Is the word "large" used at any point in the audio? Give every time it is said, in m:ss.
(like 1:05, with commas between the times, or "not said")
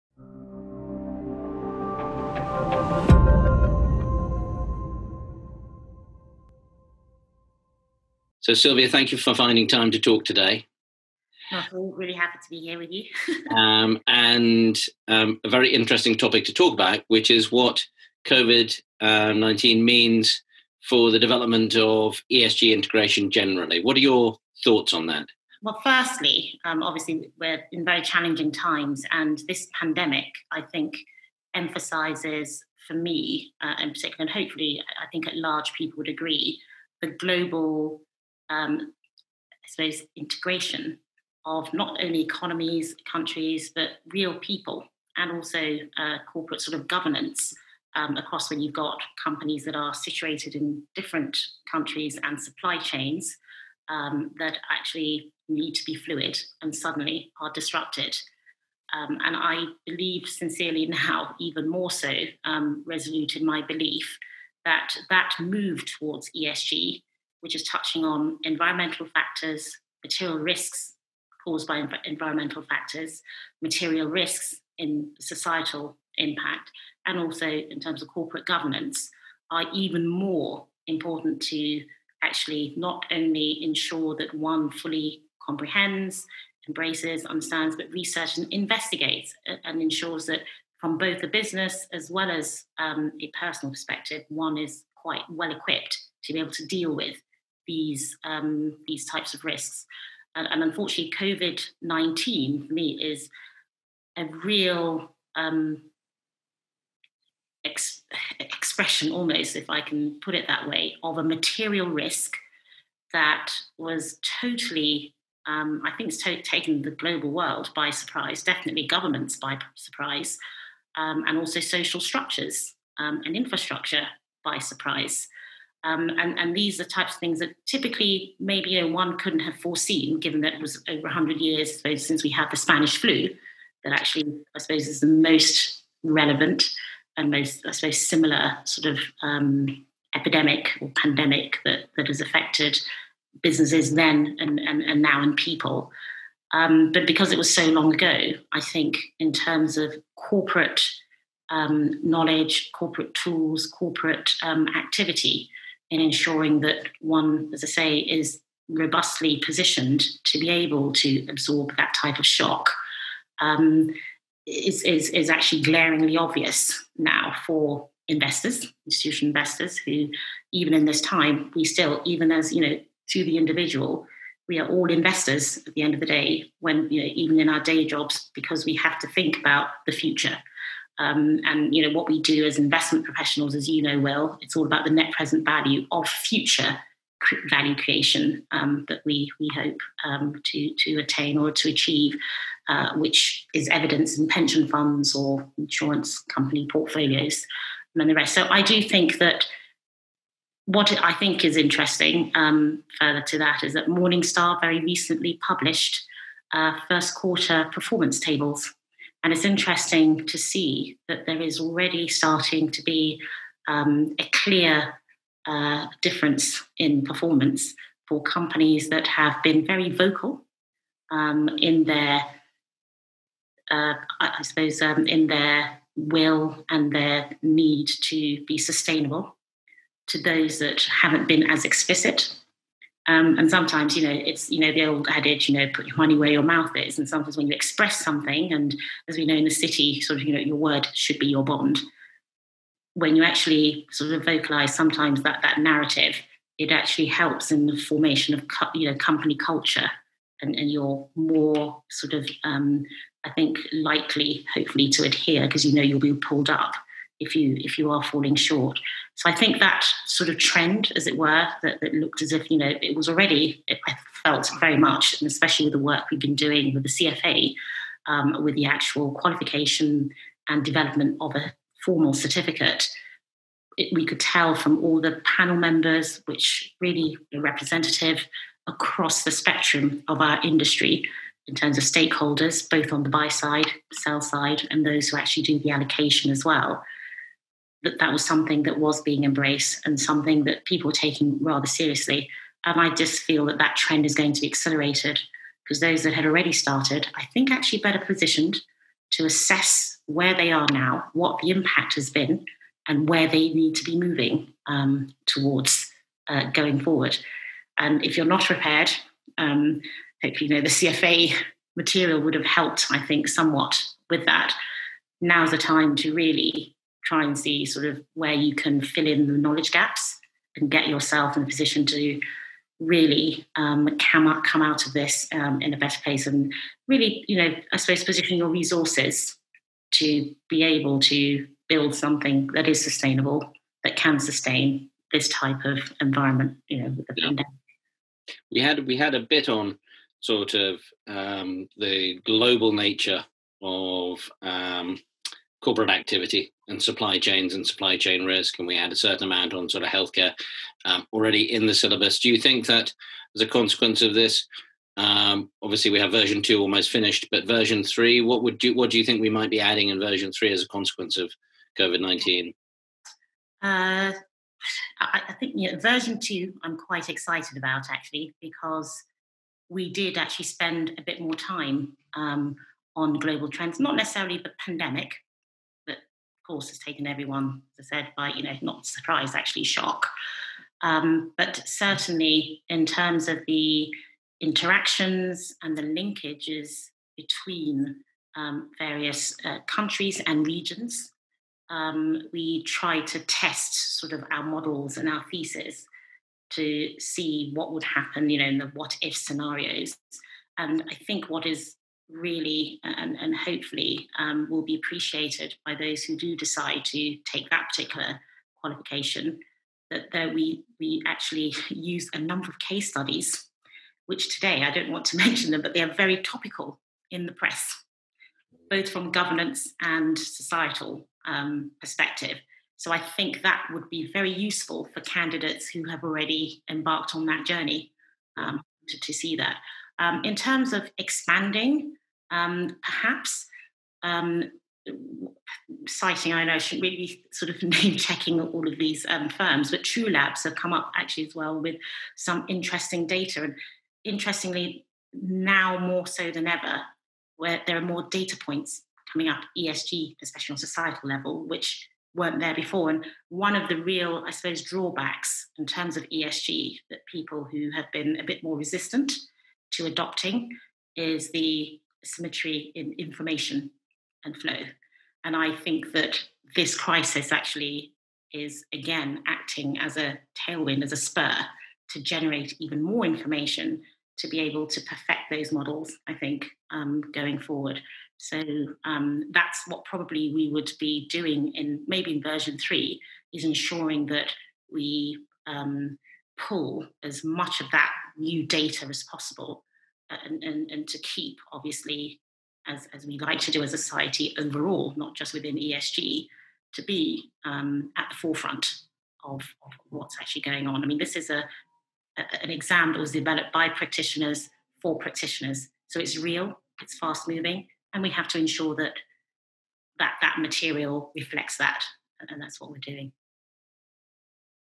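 0:35.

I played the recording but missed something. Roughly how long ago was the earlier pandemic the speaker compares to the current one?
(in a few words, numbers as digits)
over 100 years.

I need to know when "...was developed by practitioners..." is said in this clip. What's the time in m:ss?
8:22.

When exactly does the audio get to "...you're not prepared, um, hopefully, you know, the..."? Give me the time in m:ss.
5:08.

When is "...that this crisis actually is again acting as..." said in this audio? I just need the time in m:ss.
7:45.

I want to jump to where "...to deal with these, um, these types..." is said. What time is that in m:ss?
1:36.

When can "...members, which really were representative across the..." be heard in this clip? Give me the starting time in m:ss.
4:35.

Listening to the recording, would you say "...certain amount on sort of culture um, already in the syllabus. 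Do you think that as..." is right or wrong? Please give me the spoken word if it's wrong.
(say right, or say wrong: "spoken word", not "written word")
wrong: "healthcare", not "culture".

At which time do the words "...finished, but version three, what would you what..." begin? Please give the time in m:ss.
5:56.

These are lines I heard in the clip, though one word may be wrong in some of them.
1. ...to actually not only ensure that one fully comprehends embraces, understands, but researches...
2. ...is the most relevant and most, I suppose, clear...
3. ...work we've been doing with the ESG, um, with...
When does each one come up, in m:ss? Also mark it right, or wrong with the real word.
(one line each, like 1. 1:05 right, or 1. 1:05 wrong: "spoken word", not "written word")
1. 1:21 right
2. 2:14 wrong: "similar", not "clear"
3. 4:25 wrong: "CFA", not "ESG".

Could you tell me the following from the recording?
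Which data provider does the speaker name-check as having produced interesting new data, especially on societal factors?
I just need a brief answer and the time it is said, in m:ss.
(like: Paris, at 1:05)
True Labs, at 7:19.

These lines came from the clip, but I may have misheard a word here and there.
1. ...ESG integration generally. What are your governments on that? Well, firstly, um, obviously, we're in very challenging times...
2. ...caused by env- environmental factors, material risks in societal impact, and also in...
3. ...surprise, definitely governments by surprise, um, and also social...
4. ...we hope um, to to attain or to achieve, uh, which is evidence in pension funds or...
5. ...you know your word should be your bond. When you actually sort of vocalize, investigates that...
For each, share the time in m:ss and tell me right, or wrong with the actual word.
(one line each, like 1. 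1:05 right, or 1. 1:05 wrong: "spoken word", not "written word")
1. 0:22 wrong: "thoughts", not "governments"
2. 1:11 right
3. 1:57 right
4. 3:09 right
5. 4:00 wrong: "sometimes", not "investigates".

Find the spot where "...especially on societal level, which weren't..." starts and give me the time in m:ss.
7:30.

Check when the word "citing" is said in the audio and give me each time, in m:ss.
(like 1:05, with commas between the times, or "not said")
7:15.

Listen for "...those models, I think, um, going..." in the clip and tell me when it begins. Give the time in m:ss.
7:55.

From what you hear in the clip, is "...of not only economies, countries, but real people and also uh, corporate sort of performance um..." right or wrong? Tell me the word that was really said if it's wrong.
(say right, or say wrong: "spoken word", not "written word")
wrong: "governance", not "performance".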